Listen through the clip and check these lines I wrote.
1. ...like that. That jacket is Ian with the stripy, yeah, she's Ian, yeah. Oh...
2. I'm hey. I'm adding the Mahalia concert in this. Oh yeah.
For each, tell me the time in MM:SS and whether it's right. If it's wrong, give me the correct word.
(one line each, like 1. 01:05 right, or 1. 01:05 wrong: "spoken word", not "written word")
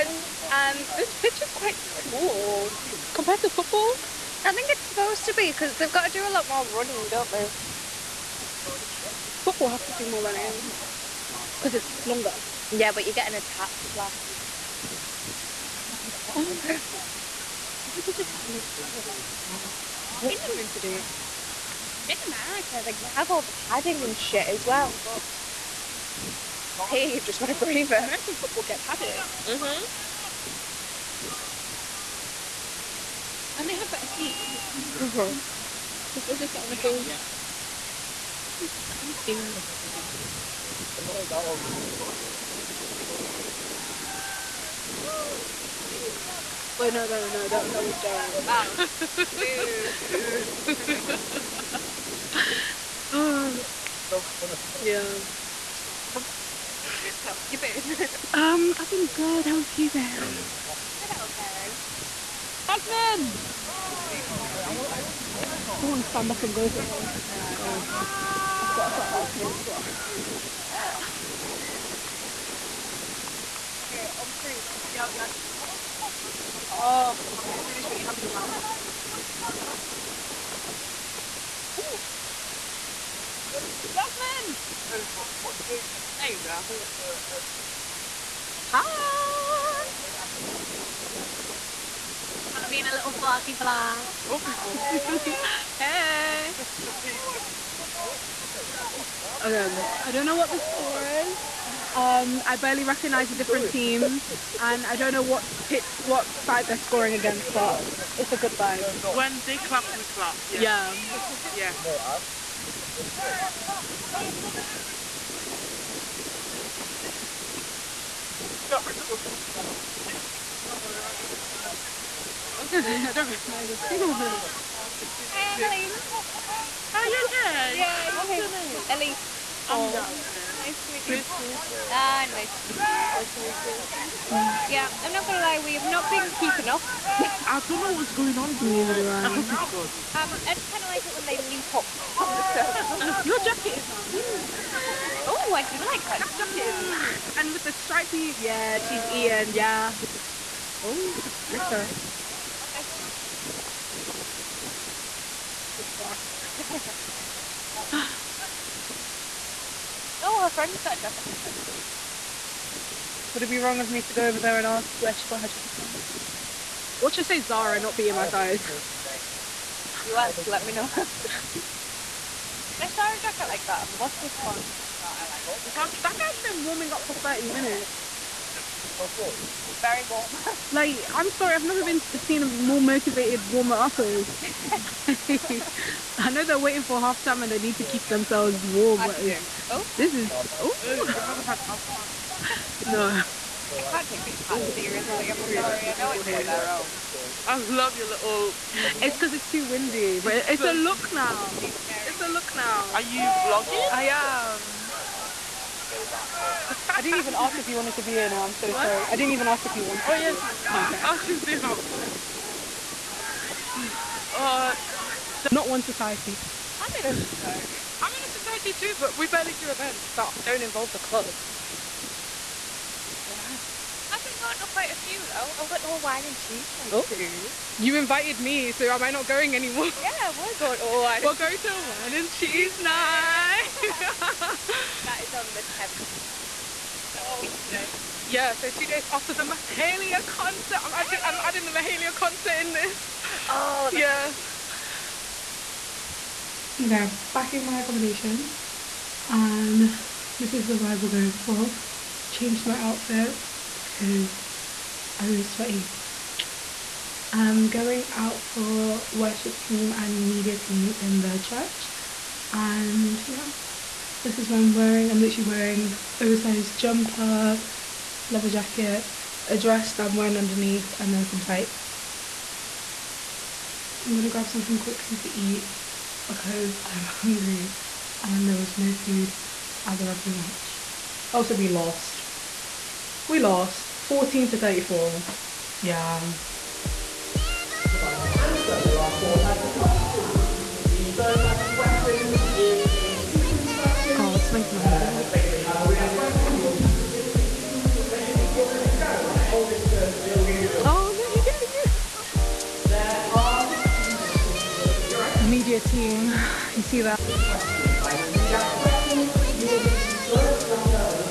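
1. 02:25 wrong: "And", not "Ian"
2. 04:00 right.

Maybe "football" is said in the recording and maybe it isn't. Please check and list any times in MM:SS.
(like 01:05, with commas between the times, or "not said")
00:03, 00:09, 00:28.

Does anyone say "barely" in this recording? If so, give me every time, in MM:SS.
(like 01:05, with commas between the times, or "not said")
01:42, 03:39.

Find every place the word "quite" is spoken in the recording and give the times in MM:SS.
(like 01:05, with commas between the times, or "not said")
00:01, 03:44.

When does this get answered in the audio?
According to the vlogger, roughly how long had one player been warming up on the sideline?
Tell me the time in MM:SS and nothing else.
02:57.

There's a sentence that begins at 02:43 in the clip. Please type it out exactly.
Would it be wrong of me to go over there and ask where she got her jacket from?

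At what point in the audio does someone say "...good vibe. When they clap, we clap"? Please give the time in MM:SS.
01:48.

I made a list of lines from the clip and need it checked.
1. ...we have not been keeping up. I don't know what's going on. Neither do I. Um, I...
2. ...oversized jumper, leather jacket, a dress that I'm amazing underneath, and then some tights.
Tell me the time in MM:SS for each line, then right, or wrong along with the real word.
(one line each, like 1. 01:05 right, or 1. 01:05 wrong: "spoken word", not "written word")
1. 02:15 right
2. 04:26 wrong: "wearing", not "amazing".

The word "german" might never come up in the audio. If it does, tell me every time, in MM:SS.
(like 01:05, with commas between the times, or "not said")
not said.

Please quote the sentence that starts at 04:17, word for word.
I'm going out for worship team and media team in the church.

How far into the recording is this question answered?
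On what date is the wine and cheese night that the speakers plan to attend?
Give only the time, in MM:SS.
03:55.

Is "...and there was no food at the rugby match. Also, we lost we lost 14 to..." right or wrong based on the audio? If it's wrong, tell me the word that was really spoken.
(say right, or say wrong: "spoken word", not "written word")
right.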